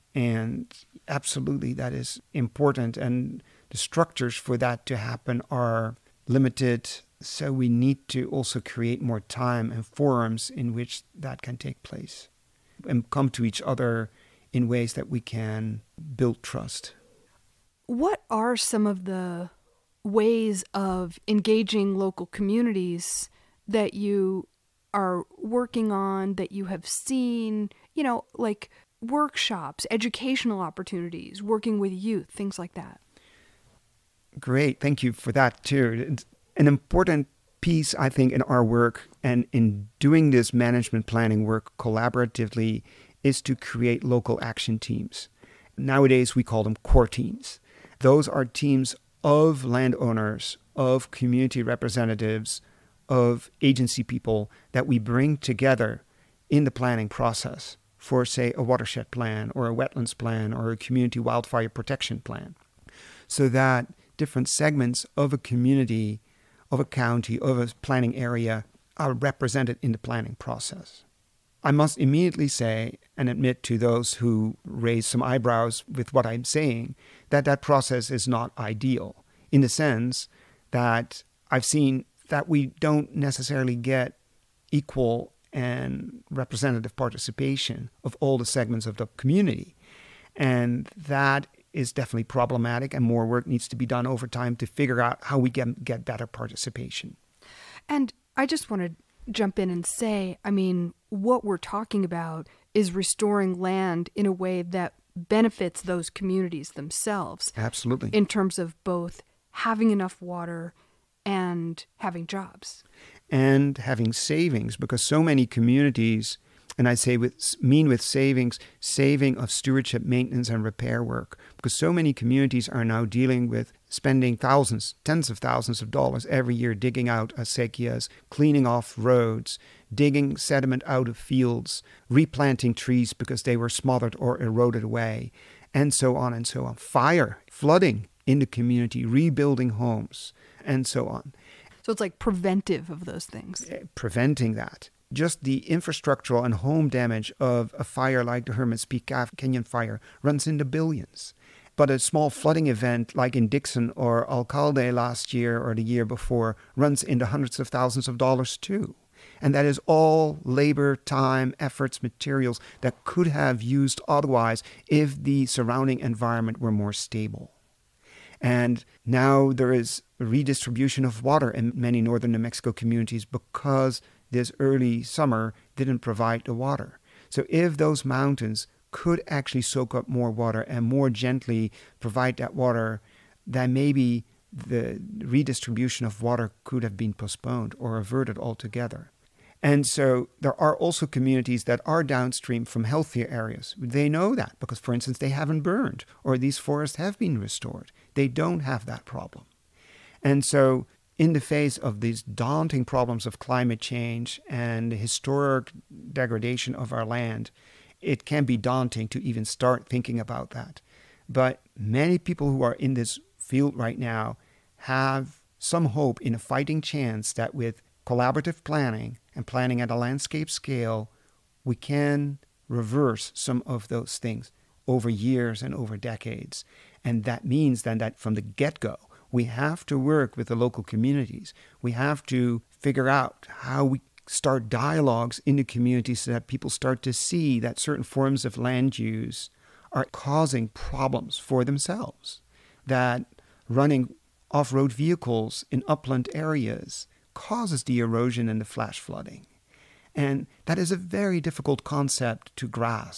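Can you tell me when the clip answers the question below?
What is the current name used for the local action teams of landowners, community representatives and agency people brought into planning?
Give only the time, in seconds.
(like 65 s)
46 s.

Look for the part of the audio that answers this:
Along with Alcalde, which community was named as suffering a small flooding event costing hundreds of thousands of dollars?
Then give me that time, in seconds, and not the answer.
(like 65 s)
153 s.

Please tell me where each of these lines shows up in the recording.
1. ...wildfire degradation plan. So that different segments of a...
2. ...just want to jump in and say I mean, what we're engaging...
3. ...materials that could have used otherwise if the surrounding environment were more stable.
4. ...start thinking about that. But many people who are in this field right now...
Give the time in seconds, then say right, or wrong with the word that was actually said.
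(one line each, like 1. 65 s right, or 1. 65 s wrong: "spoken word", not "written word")
1. 61 s wrong: "protection", not "degradation"
2. 98 s wrong: "talking", not "engaging"
3. 162 s right
4. 209 s right.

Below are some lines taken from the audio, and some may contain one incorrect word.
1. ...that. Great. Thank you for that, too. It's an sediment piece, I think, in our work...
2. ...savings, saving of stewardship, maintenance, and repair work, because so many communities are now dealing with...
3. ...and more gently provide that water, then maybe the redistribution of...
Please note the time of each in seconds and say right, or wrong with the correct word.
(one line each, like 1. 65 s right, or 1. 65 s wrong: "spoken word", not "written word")
1. 32 s wrong: "important", not "sediment"
2. 118 s right
3. 180 s right.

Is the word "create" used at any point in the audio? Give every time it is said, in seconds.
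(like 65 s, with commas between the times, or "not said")
8 s, 43 s.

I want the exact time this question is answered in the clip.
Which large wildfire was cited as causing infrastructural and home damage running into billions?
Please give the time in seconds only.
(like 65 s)
148 s.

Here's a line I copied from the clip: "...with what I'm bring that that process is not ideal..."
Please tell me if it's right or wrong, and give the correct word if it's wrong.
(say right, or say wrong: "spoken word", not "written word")
wrong: "saying", not "bring".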